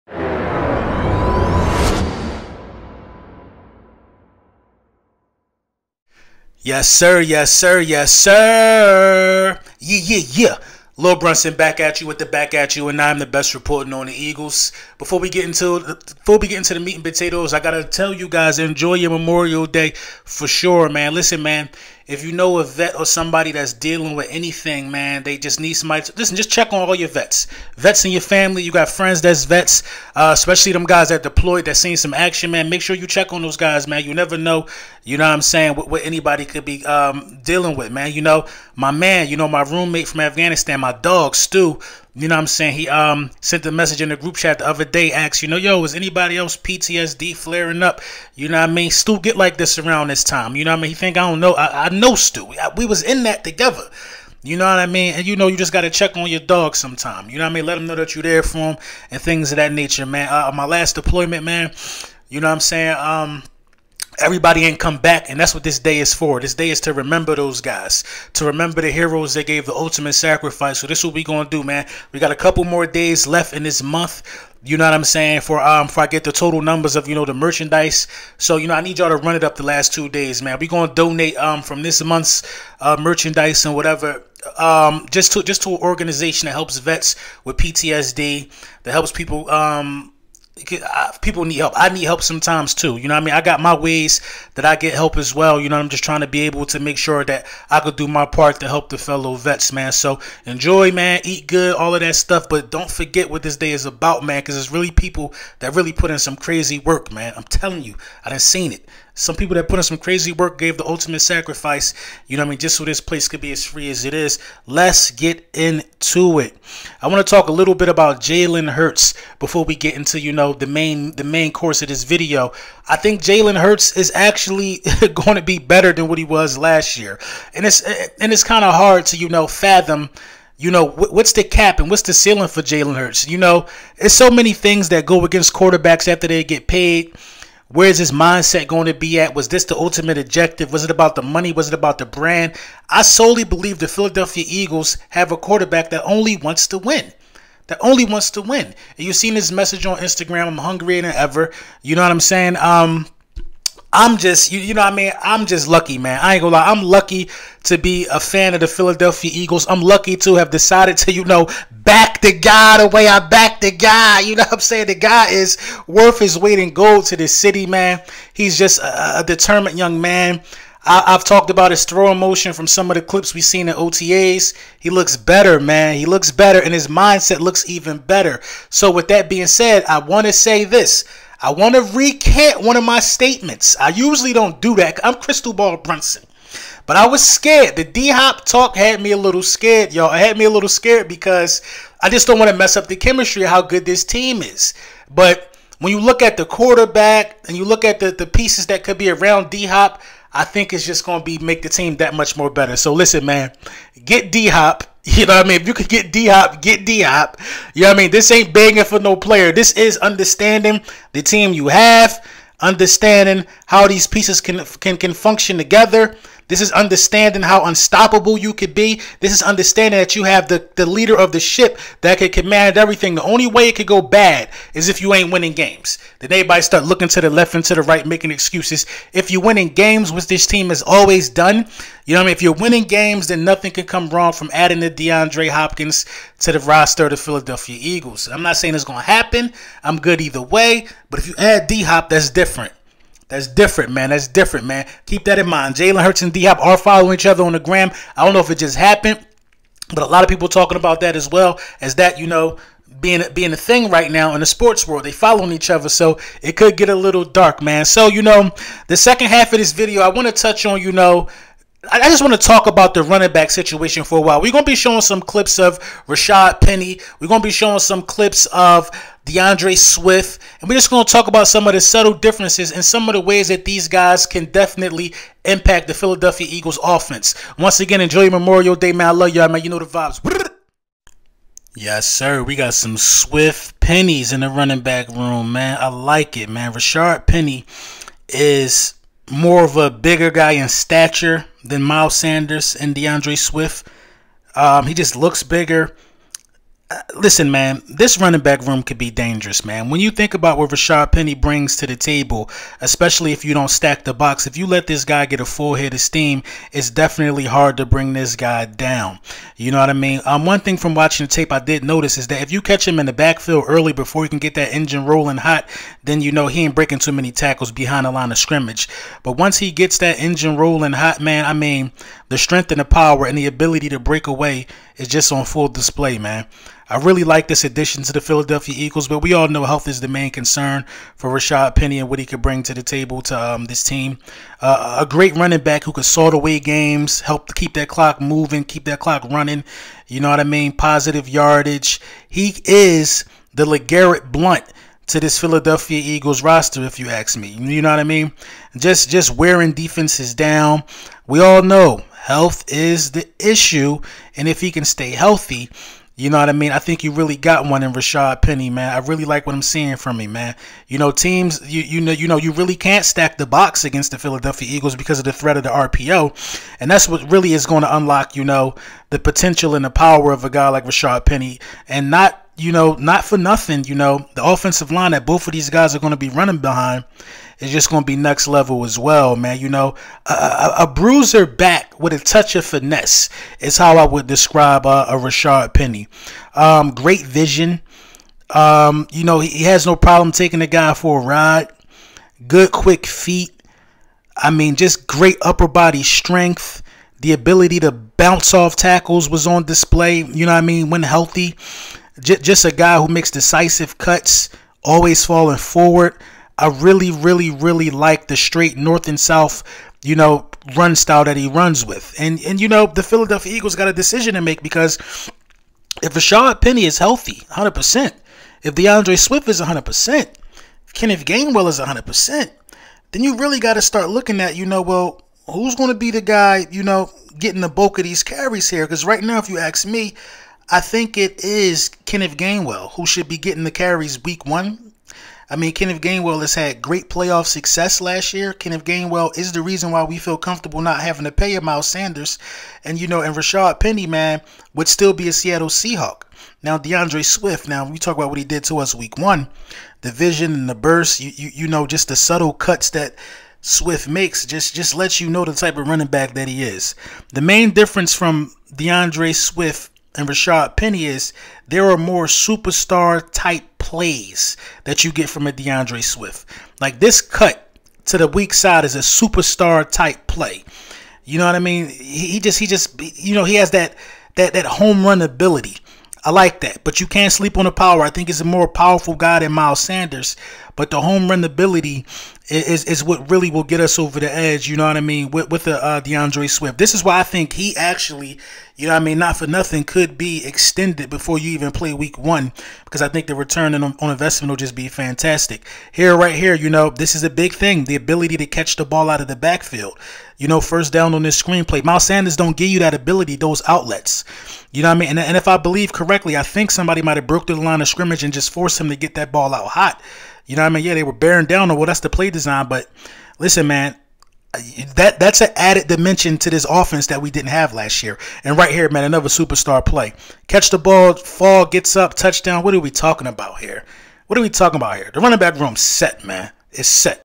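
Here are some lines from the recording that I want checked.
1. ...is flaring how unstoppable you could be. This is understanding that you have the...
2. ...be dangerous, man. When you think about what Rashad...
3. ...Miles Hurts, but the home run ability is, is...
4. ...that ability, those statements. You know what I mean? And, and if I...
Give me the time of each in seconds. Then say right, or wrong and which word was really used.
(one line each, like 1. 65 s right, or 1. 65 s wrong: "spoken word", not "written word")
1. 216 s wrong: "understanding", not "flaring"
2. 298 s right
3. 479 s wrong: "Sanders", not "Hurts"
4. 502 s wrong: "outlets", not "statements".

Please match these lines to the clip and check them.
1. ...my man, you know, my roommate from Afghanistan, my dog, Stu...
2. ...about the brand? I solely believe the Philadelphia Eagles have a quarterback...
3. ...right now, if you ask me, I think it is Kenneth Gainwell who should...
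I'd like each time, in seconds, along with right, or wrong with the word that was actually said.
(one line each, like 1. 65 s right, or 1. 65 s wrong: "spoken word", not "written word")
1. 38 s right
2. 141 s right
3. 429 s right.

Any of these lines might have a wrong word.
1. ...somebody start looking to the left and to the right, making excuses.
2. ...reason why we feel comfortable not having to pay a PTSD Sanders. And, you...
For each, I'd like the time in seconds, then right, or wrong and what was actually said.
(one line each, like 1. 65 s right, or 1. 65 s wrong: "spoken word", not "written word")
1. 226 s wrong: "everybody", not "somebody"
2. 439 s wrong: "Miles", not "PTSD".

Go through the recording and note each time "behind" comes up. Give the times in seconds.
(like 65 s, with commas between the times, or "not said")
317 s, 376 s.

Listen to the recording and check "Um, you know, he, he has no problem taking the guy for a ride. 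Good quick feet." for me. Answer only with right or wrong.
right.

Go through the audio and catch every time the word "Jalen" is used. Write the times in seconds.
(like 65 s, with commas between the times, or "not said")
118 s, 123 s, 132 s, 245 s.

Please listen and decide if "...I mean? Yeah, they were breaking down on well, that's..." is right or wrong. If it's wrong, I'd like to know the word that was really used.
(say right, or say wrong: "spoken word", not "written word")
wrong: "bearing", not "breaking".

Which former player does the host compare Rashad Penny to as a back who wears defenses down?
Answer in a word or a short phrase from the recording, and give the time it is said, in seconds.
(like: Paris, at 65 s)
LeGarrette Blunt, at 343 s.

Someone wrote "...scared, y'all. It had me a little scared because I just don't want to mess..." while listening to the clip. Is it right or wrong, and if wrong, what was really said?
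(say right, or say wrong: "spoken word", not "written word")
right.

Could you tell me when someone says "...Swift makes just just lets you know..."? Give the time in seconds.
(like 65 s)
453 s.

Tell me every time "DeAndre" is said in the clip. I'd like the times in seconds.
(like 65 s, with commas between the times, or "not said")
234 s, 269 s, 292 s, 418 s, 446 s, 458 s, 465 s, 486 s.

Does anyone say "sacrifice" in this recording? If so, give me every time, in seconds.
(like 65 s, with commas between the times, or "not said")
70 s, 111 s.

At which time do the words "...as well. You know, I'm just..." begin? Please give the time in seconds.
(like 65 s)
95 s.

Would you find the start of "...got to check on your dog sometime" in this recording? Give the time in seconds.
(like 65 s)
55 s.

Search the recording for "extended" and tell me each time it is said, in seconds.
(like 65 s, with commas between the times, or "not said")
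490 s.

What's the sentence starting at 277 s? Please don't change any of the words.
Once again, enjoy Memorial Day, man.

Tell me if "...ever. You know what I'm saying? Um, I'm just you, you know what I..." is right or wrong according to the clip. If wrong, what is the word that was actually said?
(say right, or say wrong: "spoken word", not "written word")
right.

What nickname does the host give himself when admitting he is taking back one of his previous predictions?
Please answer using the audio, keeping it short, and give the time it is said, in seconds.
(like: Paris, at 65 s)
Crystal Ball Brunson, at 185 s.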